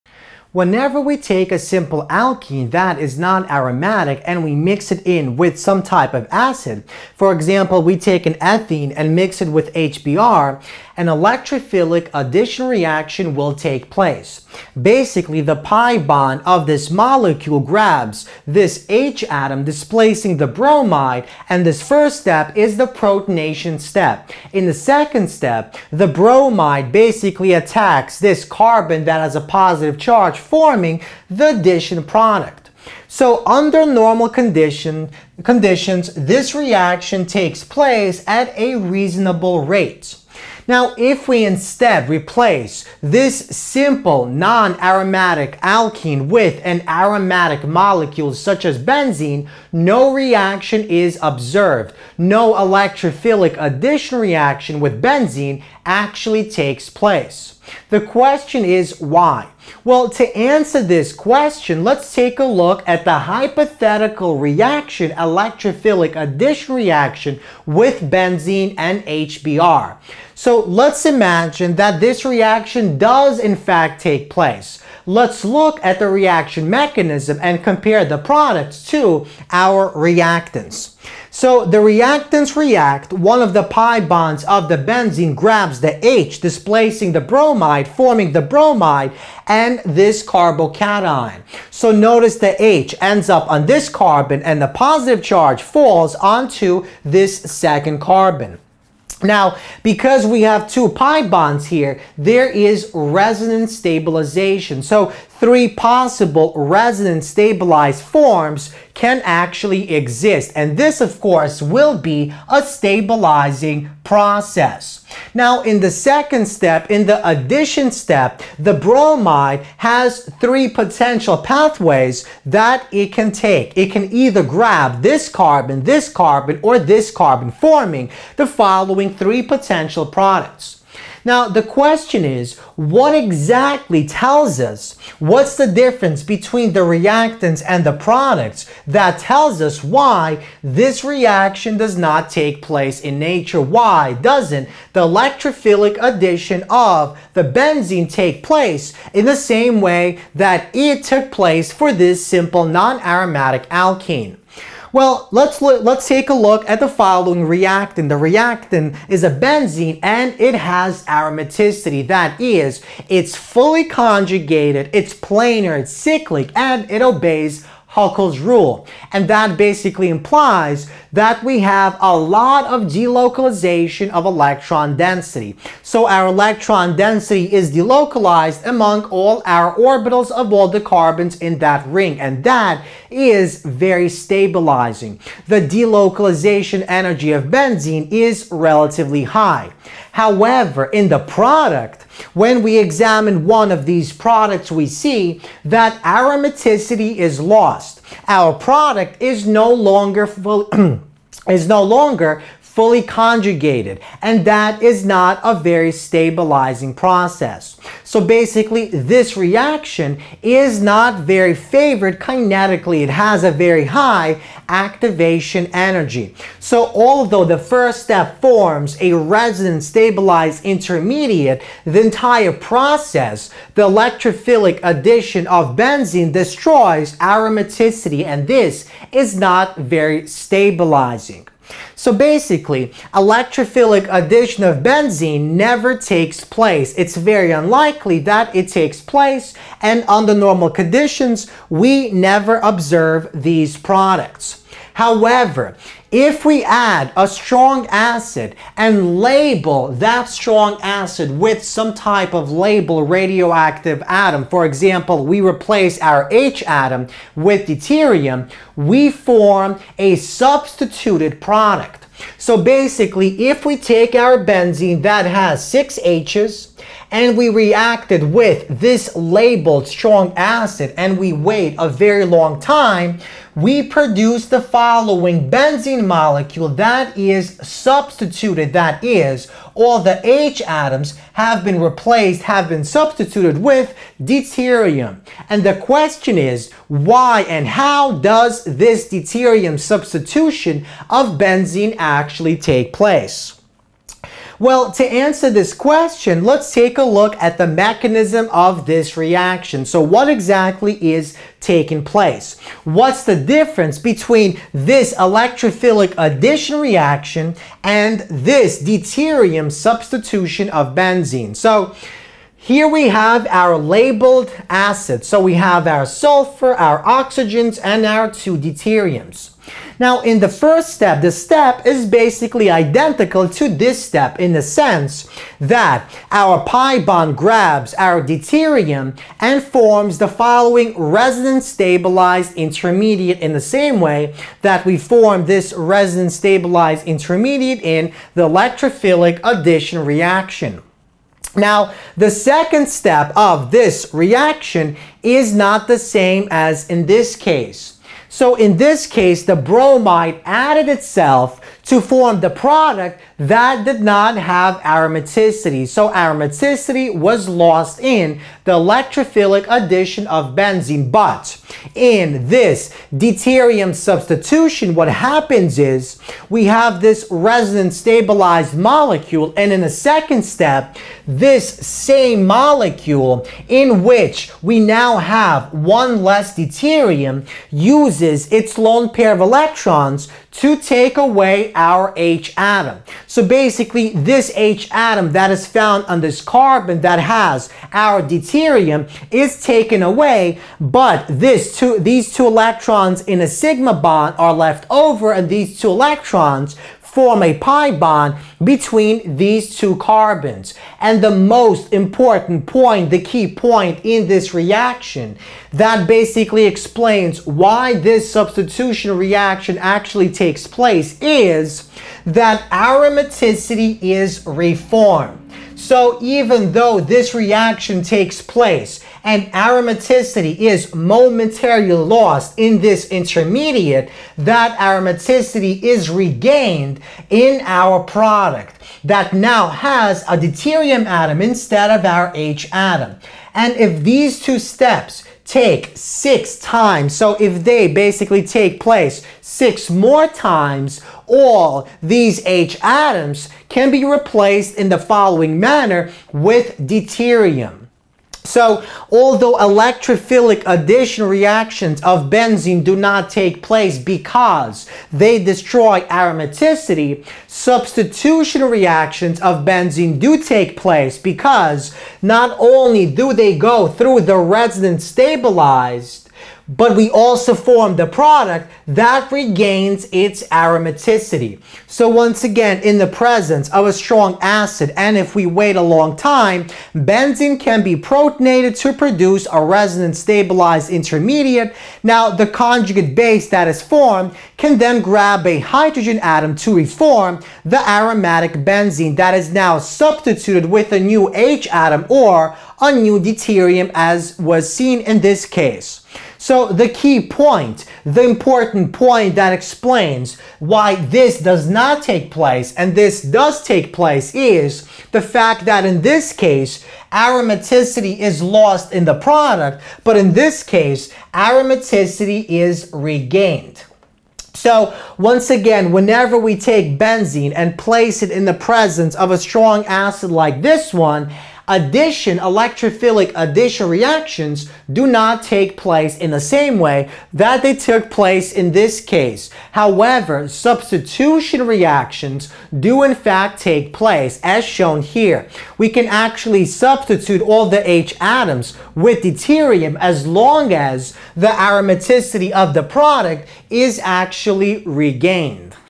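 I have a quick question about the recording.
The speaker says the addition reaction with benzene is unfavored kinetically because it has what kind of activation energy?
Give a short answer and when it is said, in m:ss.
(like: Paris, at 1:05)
very high, at 3:33.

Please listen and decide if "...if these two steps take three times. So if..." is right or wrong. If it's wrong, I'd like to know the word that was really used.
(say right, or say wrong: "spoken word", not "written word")
wrong: "six", not "three".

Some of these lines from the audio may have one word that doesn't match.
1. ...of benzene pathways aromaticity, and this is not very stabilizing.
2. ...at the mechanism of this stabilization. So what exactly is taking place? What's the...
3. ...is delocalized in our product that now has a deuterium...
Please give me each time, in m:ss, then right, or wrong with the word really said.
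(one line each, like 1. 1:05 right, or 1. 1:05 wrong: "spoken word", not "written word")
1. 3:45 wrong: "destroys", not "pathways"
2. 4:57 wrong: "reaction", not "stabilization"
3. 7:05 wrong: "regained", not "delocalized".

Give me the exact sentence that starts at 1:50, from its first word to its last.
And this, of course, will be a stabilizing process.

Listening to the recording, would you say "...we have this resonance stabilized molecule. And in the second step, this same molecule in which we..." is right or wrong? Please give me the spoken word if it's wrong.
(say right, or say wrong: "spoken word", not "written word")
right.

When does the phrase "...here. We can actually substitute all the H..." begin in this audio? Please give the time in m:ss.
8:55.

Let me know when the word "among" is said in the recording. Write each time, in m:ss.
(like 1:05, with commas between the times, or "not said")
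2:58.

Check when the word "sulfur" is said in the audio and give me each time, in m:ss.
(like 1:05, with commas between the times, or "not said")
5:16.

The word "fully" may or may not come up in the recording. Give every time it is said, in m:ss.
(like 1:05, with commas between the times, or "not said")
2:43, 3:22.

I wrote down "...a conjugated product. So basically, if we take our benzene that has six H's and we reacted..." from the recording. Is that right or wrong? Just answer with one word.
wrong.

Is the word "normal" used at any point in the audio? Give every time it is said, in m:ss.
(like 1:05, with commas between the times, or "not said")
0:33, 4:00.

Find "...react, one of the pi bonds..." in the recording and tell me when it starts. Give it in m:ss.
1:22.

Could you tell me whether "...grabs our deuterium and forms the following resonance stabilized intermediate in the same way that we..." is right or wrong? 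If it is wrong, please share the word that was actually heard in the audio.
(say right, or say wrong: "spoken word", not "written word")
right.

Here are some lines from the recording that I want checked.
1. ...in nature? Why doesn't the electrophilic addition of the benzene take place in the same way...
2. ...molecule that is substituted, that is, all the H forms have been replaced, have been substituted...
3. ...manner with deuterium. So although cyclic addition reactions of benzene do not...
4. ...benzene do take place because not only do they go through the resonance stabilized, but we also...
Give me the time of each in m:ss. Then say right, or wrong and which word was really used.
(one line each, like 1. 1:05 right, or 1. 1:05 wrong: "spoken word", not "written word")
1. 2:23 right
2. 4:36 wrong: "atoms", not "forms"
3. 7:25 wrong: "electrophilic", not "cyclic"
4. 7:39 right.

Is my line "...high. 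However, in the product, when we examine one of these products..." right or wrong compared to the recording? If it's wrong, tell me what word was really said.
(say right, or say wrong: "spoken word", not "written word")
right.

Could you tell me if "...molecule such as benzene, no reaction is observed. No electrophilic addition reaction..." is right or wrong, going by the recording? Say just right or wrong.
right.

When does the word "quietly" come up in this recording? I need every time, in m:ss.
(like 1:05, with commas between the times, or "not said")
not said.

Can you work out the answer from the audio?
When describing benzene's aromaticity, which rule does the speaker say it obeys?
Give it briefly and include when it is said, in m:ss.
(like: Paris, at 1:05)
Huckel's rule, at 2:47.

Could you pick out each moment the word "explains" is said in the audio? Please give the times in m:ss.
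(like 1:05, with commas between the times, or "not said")
6:46, 8:19.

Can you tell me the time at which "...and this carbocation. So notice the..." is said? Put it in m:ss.
1:29.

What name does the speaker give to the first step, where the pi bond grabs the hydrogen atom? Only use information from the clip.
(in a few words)
protonation step.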